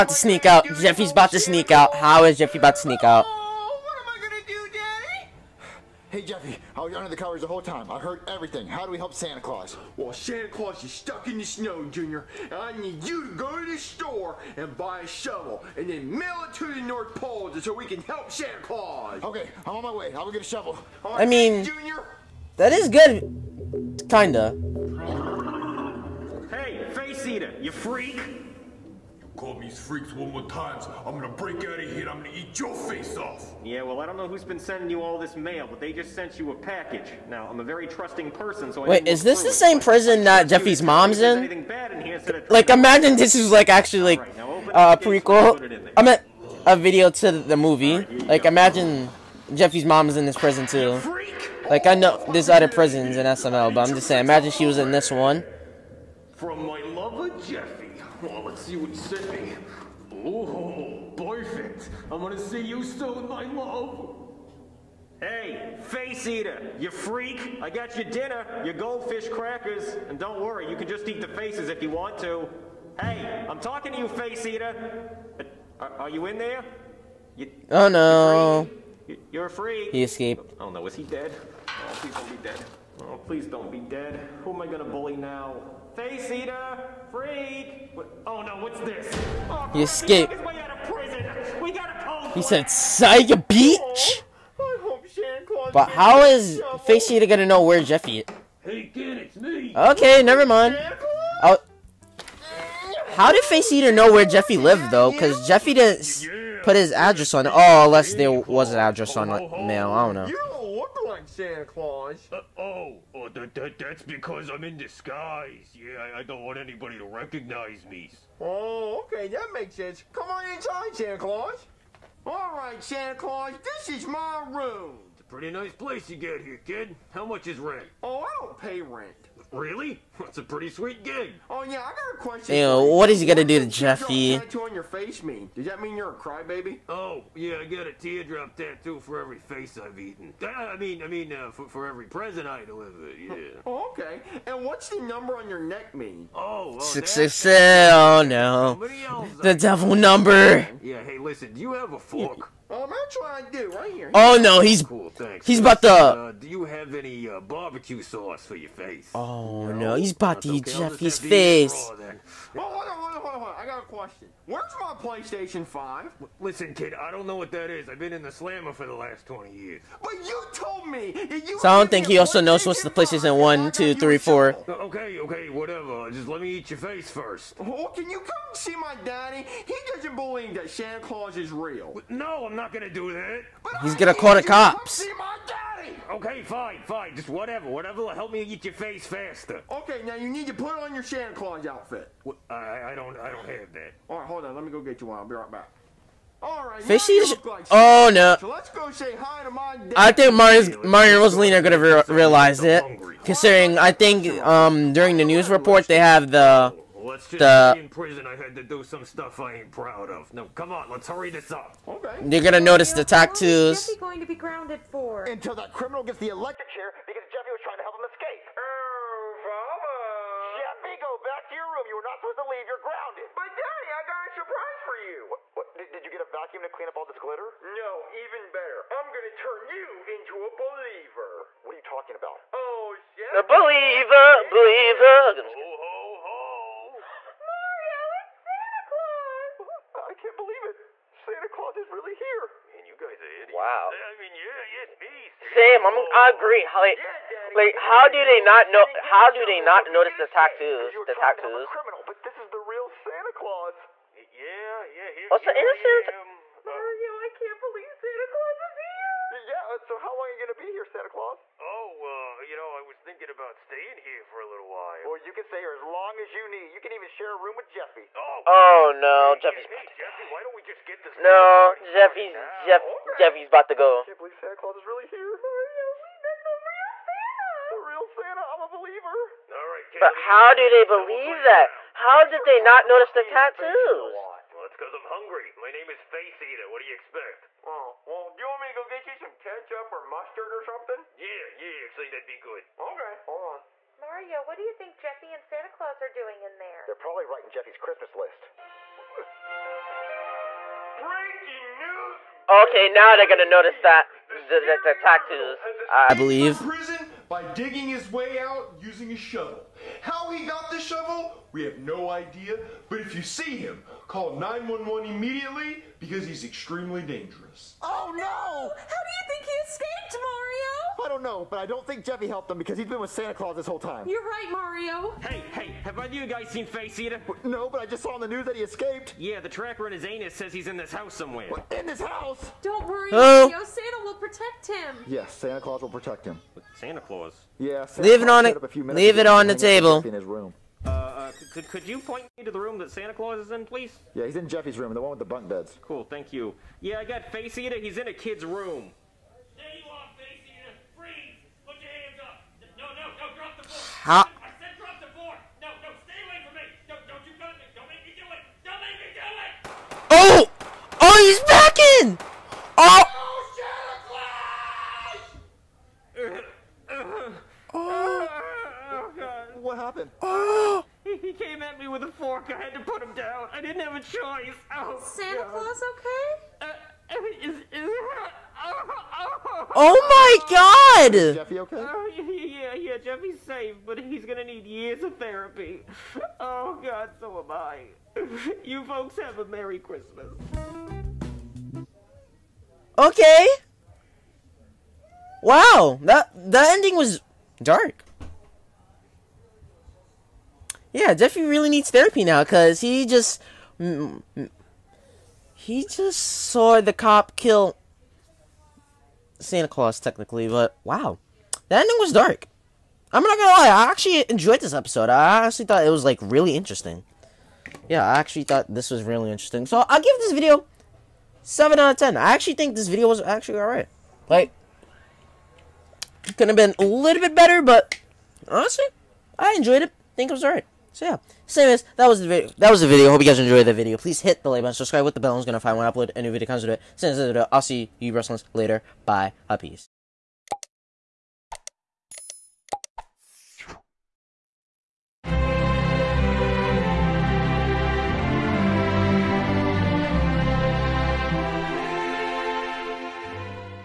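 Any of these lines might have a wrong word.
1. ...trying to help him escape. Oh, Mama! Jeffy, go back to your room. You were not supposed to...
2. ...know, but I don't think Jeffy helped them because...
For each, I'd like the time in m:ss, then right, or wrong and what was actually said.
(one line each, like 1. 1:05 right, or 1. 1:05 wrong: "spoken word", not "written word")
1. 3:37 right
2. 5:21 right.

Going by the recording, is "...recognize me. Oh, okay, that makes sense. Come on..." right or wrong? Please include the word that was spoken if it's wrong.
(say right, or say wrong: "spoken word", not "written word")
right.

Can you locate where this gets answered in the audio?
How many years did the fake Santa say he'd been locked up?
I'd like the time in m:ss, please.
2:48.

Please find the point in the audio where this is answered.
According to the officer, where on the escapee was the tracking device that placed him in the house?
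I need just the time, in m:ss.
5:29.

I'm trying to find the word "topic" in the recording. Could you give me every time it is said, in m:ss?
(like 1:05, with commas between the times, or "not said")
not said.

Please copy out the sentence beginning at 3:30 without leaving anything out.
No, come on, let's hurry this up.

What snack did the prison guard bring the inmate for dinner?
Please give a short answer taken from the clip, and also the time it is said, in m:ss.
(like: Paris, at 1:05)
goldfish crackers, at 1:08.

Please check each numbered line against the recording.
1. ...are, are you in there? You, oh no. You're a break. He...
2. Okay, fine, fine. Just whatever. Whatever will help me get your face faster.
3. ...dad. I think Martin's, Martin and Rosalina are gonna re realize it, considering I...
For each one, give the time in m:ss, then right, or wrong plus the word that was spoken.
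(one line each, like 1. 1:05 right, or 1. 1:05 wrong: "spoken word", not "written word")
1. 1:15 wrong: "freak", not "break"
2. 3:06 right
3. 3:19 right.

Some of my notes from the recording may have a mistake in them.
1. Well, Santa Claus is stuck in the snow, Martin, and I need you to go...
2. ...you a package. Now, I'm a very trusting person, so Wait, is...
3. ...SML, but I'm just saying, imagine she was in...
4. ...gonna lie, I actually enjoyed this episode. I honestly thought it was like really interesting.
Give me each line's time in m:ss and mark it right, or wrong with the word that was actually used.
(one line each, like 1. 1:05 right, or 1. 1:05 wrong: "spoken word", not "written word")
1. 0:09 wrong: "Junior", not "Martin"
2. 0:36 right
3. 0:53 right
4. 6:53 right.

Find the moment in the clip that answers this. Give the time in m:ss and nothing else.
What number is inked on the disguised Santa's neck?
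2:26.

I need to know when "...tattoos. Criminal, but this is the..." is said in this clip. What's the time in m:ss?
4:11.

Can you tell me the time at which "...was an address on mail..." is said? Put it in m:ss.
1:48.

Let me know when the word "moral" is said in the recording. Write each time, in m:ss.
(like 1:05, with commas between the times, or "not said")
not said.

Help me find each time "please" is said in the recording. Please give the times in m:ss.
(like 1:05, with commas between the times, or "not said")
1:23, 5:43, 7:13.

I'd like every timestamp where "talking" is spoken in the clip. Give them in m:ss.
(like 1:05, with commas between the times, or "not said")
1:13, 3:51.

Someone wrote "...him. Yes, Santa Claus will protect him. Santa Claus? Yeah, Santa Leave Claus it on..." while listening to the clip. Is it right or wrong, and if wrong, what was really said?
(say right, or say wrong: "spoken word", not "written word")
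right.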